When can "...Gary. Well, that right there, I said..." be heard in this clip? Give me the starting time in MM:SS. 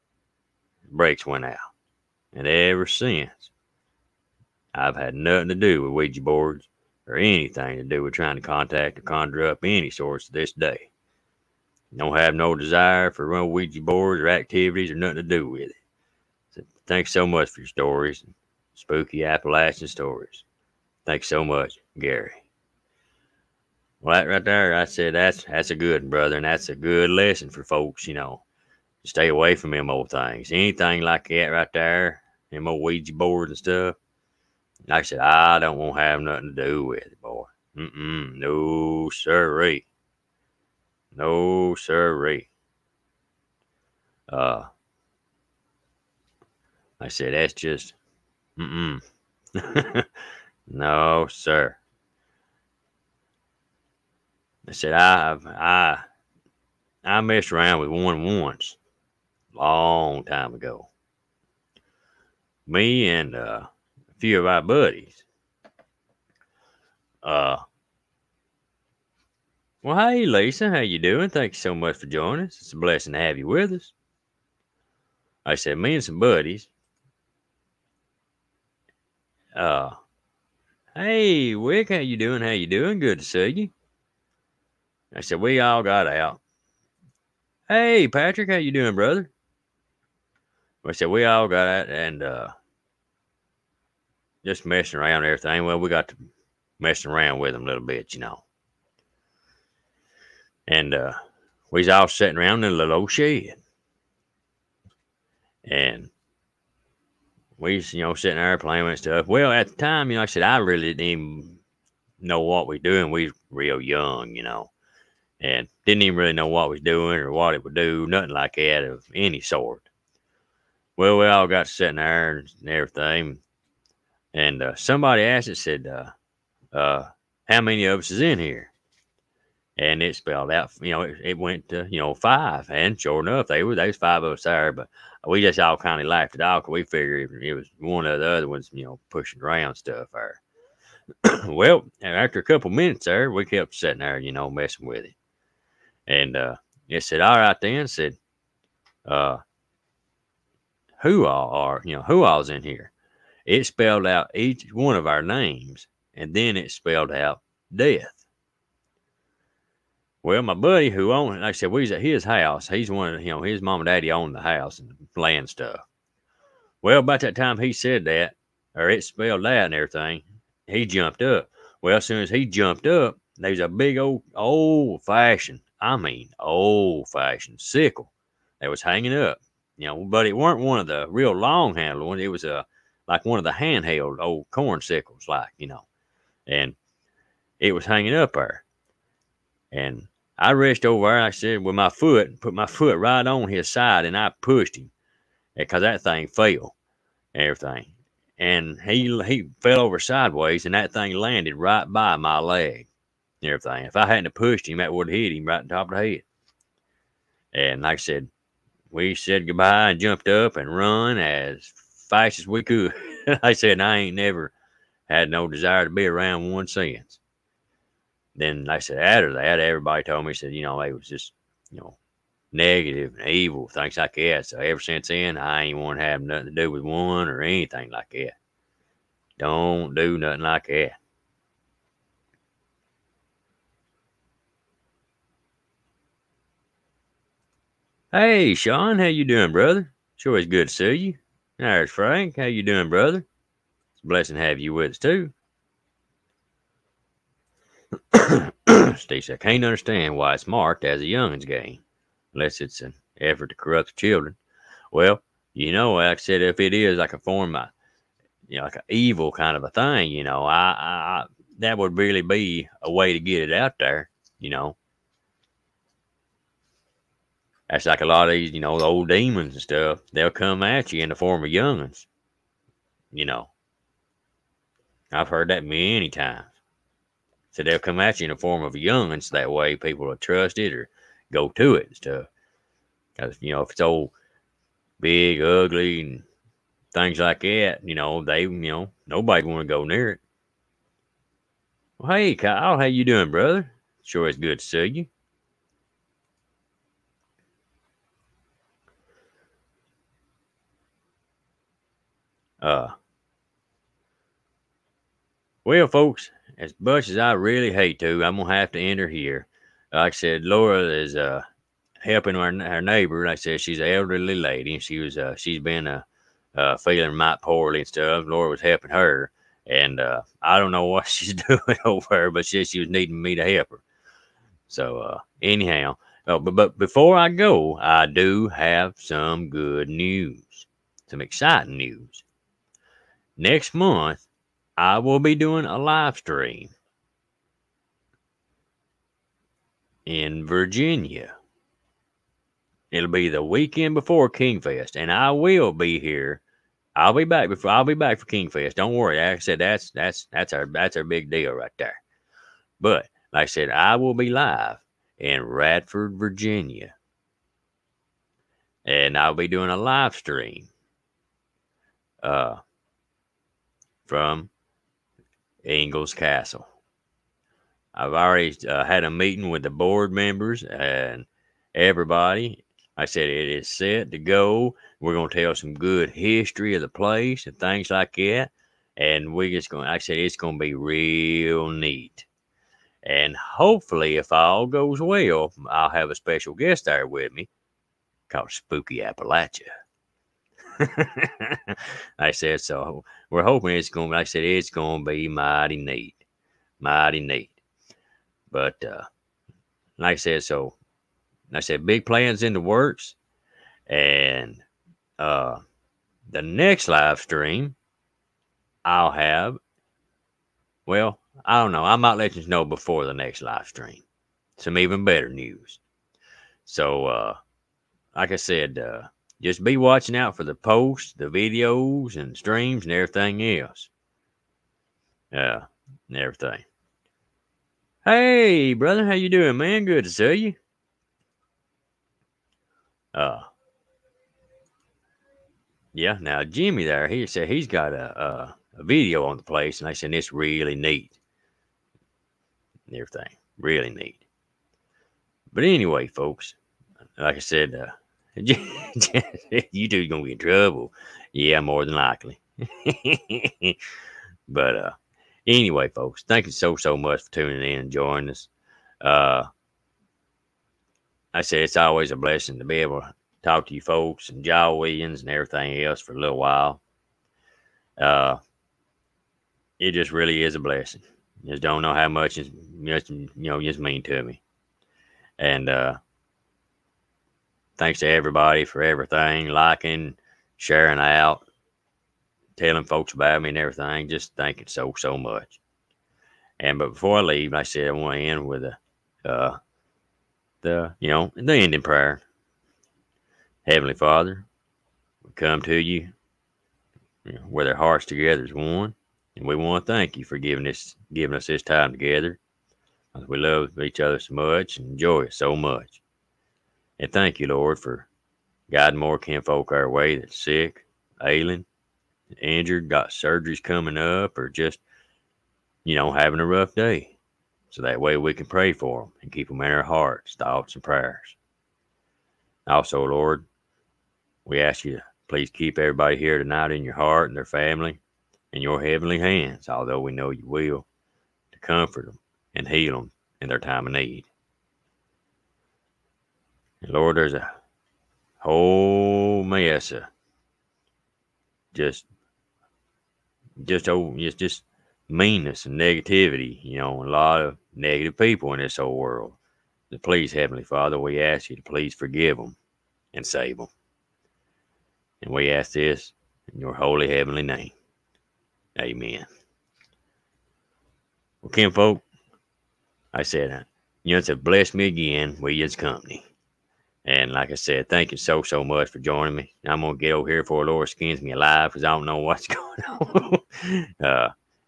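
00:21.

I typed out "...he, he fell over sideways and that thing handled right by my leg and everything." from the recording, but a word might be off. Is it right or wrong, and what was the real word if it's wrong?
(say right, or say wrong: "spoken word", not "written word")
wrong: "landed", not "handled".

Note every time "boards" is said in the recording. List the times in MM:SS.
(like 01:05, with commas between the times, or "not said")
00:06, 00:13, 00:33, 06:09.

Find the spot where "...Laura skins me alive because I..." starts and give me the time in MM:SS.
09:30.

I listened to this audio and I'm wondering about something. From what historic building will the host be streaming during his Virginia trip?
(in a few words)
Ingalls Castle.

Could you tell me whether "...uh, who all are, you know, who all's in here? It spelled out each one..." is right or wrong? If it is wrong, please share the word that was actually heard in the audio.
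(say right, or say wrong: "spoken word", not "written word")
right.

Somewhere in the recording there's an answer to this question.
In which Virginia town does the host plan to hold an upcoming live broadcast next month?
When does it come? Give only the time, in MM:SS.
05:55.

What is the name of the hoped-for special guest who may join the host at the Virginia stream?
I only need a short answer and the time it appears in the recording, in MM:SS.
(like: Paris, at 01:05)
Spooky Appalachia, at 06:28.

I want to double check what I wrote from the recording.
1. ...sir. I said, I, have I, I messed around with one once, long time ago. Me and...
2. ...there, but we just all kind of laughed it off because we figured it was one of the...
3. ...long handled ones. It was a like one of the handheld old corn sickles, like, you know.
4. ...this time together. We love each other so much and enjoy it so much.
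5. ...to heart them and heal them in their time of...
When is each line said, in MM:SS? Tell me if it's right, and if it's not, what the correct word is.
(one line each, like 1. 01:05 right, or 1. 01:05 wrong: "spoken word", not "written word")
1. 00:51 right
2. 02:14 right
3. 03:01 right
4. 08:21 right
5. 08:51 wrong: "comfort", not "heart".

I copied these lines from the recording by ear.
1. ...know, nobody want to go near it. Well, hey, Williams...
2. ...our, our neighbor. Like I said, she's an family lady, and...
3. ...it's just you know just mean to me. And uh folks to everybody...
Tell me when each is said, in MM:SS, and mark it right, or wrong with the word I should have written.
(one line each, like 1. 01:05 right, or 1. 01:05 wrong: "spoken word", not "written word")
1. 04:48 wrong: "Kyle", not "Williams"
2. 05:12 wrong: "elderly", not "family"
3. 07:52 wrong: "thanks", not "folks".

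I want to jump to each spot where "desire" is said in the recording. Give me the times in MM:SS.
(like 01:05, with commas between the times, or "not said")
00:12, 03:35.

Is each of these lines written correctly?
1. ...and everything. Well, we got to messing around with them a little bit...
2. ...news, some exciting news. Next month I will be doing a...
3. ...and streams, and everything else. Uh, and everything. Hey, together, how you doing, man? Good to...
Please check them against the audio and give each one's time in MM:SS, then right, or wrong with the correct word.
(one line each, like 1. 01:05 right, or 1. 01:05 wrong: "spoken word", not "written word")
1. 01:35 right
2. 05:29 right
3. 07:02 wrong: "brother", not "together".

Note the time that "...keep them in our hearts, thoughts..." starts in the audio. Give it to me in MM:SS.
08:39.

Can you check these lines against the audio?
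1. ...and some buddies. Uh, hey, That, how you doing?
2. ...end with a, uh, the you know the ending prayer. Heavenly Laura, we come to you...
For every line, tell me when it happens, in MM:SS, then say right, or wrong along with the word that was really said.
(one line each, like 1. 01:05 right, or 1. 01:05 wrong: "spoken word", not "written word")
1. 01:15 wrong: "Wick", not "That"
2. 08:08 wrong: "Father", not "Laura".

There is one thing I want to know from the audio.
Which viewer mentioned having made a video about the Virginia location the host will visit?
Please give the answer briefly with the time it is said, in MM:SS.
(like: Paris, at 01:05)
Jimmy, at 07:16.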